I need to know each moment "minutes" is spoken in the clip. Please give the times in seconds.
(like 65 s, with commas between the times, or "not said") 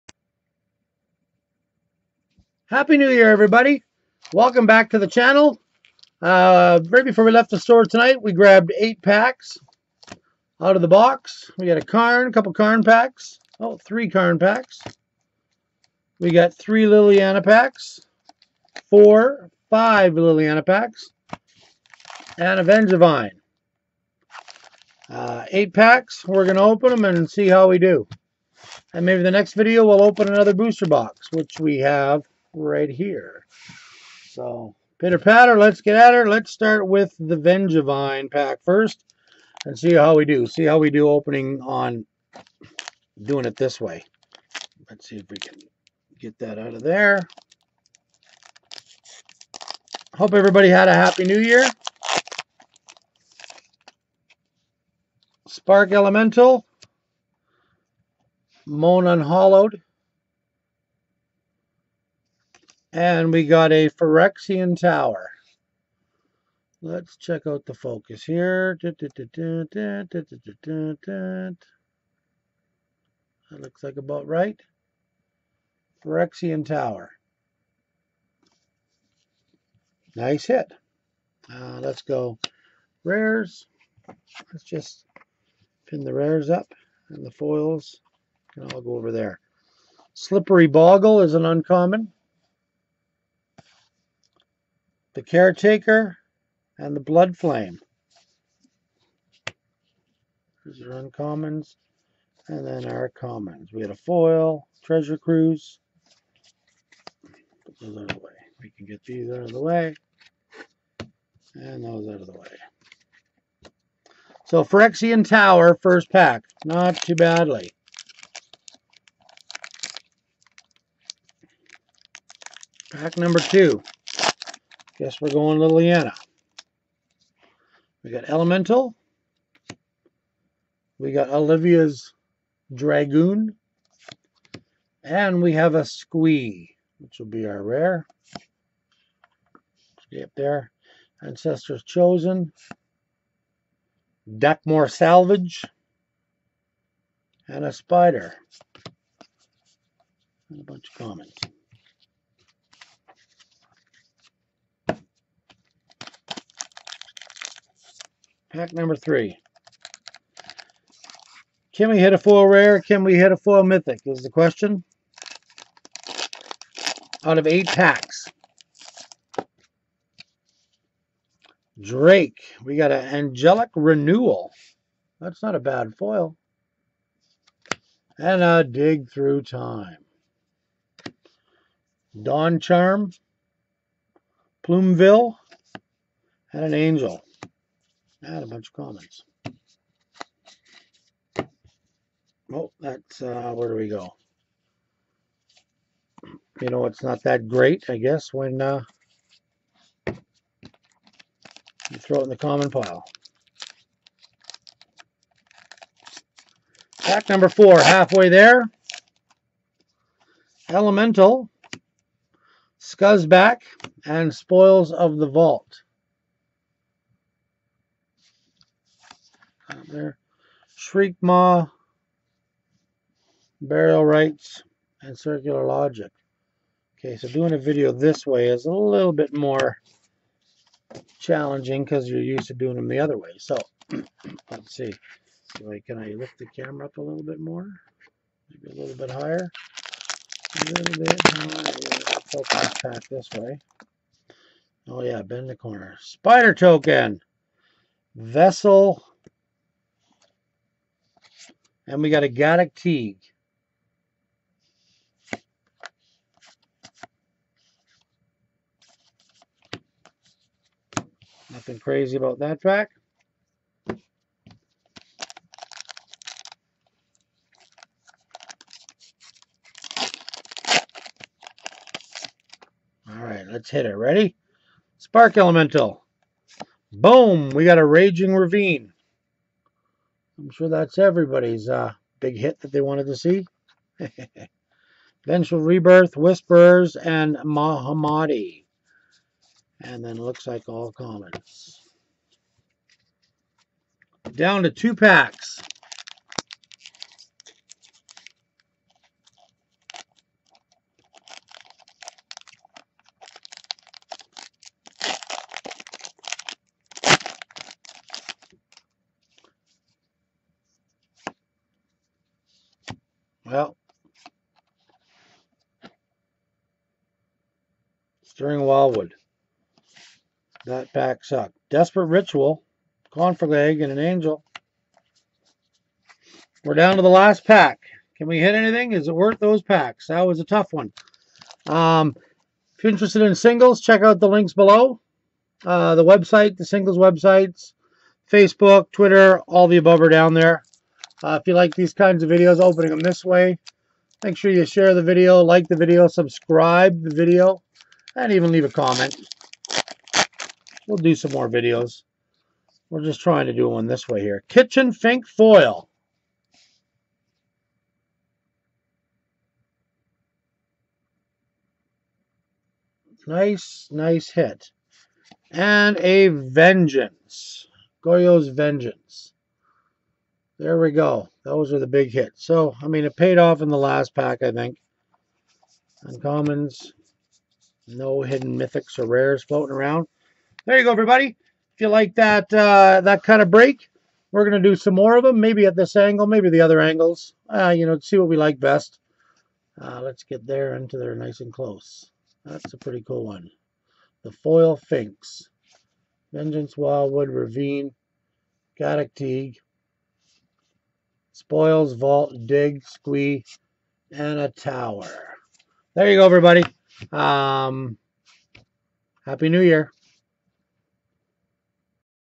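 not said.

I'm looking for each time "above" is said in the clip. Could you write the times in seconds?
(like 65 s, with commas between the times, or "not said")
339 s.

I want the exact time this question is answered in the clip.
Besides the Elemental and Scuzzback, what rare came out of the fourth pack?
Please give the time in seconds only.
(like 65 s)
214 s.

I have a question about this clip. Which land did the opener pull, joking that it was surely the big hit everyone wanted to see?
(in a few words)
Raging Ravine.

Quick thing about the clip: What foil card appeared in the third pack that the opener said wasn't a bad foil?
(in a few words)
Angelic Renewal.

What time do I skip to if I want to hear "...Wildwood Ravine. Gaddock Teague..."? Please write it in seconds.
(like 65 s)
396 s.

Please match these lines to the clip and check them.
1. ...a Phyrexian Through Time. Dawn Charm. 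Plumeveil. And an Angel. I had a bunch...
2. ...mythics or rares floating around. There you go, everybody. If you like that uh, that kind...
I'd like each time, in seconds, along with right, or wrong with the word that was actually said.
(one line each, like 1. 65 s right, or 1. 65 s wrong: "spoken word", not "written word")
1. 178 s wrong: "Dig", not "Phyrexian"
2. 378 s right.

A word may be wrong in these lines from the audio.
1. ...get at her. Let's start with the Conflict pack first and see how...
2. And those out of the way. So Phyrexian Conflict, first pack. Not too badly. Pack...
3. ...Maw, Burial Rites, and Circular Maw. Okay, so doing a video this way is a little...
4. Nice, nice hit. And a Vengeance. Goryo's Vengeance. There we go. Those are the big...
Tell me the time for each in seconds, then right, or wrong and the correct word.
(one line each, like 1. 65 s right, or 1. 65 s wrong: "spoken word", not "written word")
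1. 35 s wrong: "Vengevine", not "Conflict"
2. 111 s wrong: "Tower", not "Conflict"
3. 221 s wrong: "Logic", not "Maw"
4. 363 s right.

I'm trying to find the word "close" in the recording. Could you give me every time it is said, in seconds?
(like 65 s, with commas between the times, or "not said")
391 s.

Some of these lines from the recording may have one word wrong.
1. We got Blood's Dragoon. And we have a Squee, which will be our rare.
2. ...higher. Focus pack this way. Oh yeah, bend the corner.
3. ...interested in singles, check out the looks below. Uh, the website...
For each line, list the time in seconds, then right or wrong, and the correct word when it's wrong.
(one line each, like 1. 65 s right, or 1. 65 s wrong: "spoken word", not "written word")
1. 130 s wrong: "Olivia", not "Blood"
2. 241 s right
3. 332 s wrong: "links", not "looks".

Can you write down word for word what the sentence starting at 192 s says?
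Oh, that's, uh, where do we go?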